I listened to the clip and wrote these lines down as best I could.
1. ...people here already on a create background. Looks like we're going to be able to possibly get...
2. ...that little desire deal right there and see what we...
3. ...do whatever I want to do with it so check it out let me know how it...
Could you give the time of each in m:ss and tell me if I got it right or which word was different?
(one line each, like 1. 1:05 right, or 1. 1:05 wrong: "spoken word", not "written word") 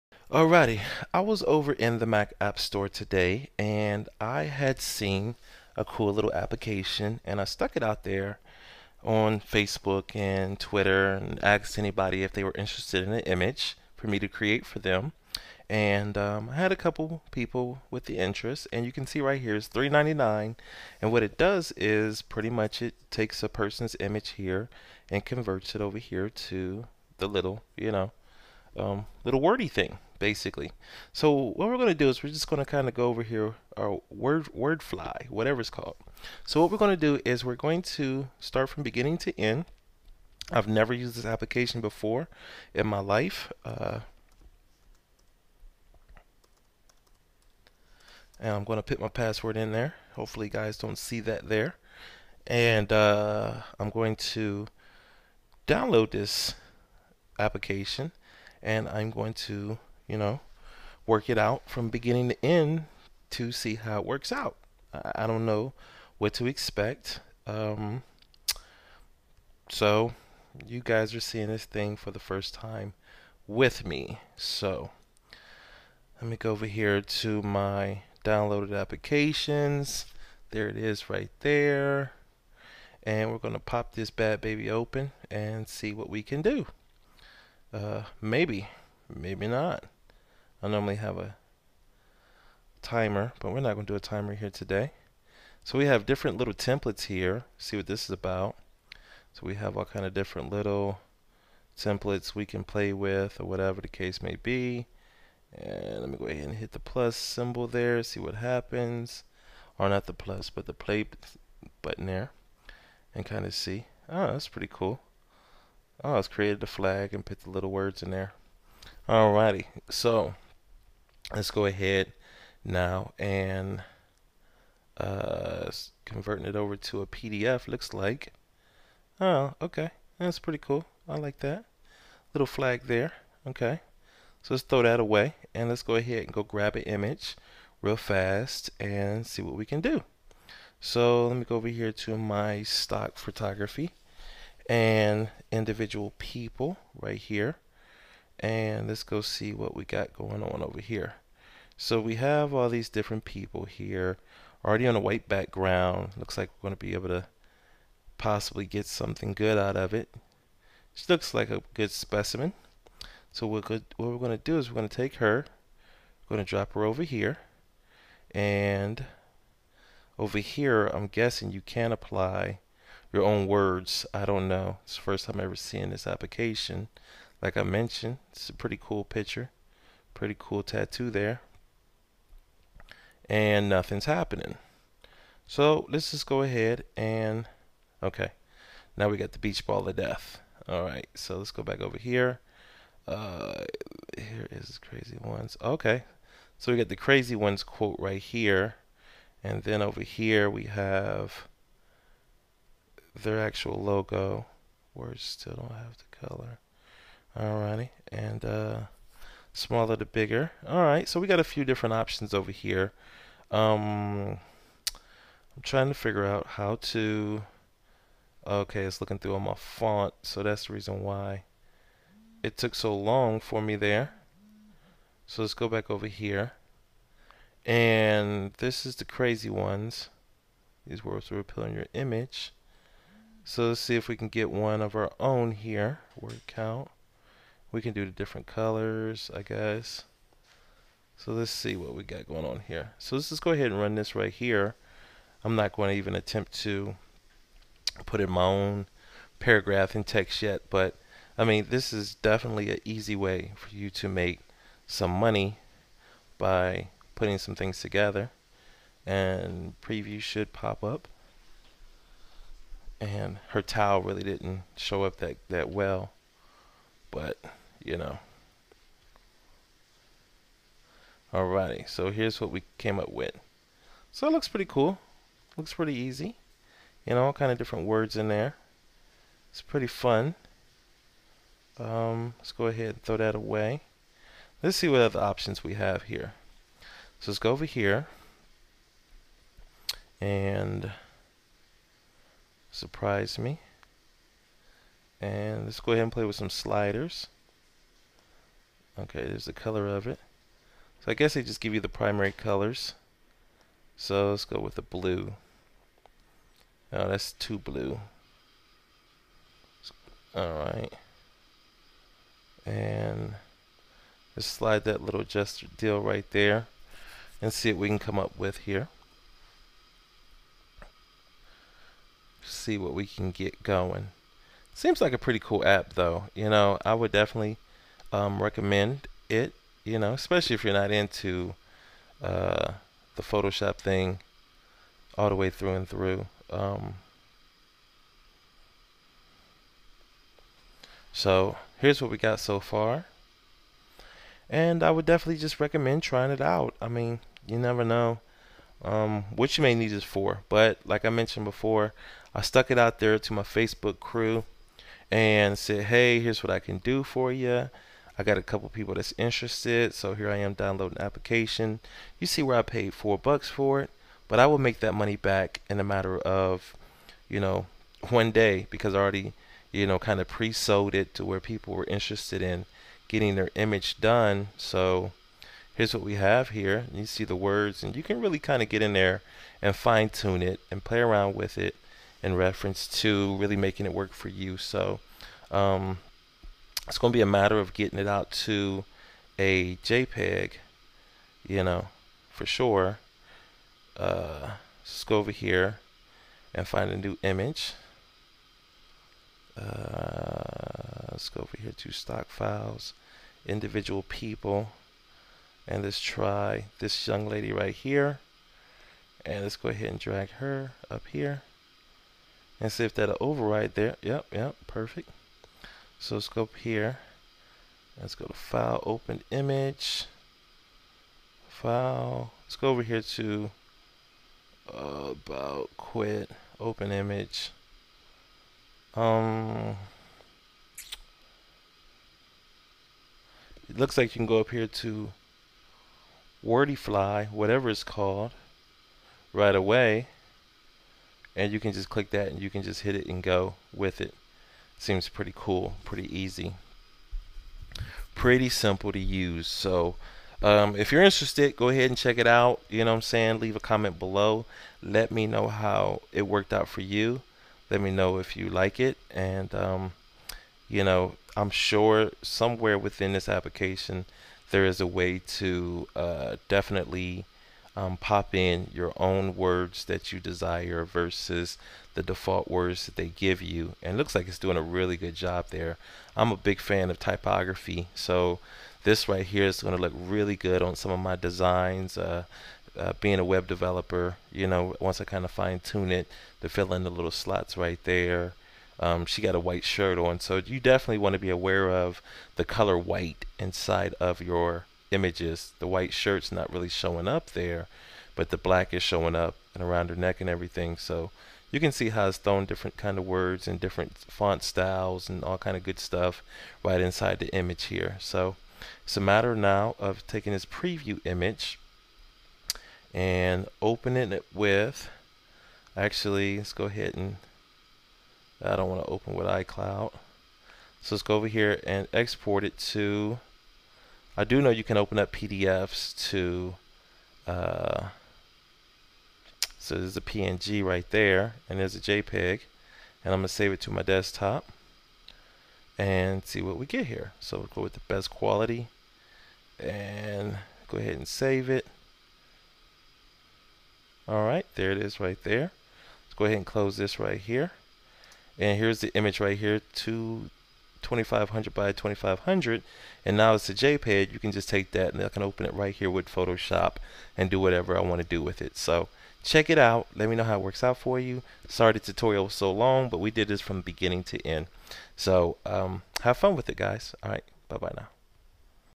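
1. 2:33 wrong: "white", not "create"
2. 5:14 wrong: "gesture", not "desire"
3. 9:17 right.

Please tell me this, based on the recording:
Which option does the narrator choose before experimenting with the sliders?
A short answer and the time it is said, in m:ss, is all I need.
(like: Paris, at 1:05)
Surprise me, at 4:52.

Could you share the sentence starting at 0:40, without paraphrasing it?
I've never used this application before in my life.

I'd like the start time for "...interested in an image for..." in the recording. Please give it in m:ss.
0:12.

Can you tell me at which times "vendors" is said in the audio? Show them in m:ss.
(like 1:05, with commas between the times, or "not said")
not said.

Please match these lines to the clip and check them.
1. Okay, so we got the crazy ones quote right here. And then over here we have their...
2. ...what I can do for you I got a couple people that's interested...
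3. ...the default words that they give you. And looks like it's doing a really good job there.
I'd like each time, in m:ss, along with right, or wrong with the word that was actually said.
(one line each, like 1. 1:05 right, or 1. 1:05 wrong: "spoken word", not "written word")
1. 3:15 right
2. 5:56 right
3. 7:51 right.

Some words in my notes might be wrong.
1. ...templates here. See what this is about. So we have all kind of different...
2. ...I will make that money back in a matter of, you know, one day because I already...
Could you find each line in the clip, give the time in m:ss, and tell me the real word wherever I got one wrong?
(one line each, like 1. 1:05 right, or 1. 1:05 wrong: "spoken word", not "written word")
1. 1:36 right
2. 6:04 right.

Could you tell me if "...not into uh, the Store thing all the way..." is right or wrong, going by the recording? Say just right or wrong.
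wrong.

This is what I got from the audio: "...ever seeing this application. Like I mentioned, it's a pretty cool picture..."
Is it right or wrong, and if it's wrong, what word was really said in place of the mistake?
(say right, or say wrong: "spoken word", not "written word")
right.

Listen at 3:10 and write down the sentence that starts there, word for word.
All right, so let's go back over here.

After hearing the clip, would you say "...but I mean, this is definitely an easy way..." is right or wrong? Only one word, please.
right.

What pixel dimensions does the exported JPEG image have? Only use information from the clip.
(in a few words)
2500 by 2500.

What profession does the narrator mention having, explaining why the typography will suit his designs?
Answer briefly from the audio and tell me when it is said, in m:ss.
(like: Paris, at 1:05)
web developer, at 8:03.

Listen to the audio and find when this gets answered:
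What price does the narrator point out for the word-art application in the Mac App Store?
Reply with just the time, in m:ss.
0:19.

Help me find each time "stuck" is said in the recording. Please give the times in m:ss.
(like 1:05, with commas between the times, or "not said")
0:07, 5:52.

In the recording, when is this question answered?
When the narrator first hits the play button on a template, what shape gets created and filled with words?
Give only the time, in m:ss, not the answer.
1:56.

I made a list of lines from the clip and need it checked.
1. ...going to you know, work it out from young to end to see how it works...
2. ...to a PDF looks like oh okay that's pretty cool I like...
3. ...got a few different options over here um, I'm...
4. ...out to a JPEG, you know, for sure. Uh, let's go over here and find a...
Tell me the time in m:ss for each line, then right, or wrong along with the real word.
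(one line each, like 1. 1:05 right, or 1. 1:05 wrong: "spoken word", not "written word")
1. 0:59 wrong: "beginning", not "young"
2. 2:06 right
3. 3:31 right
4. 6:28 right.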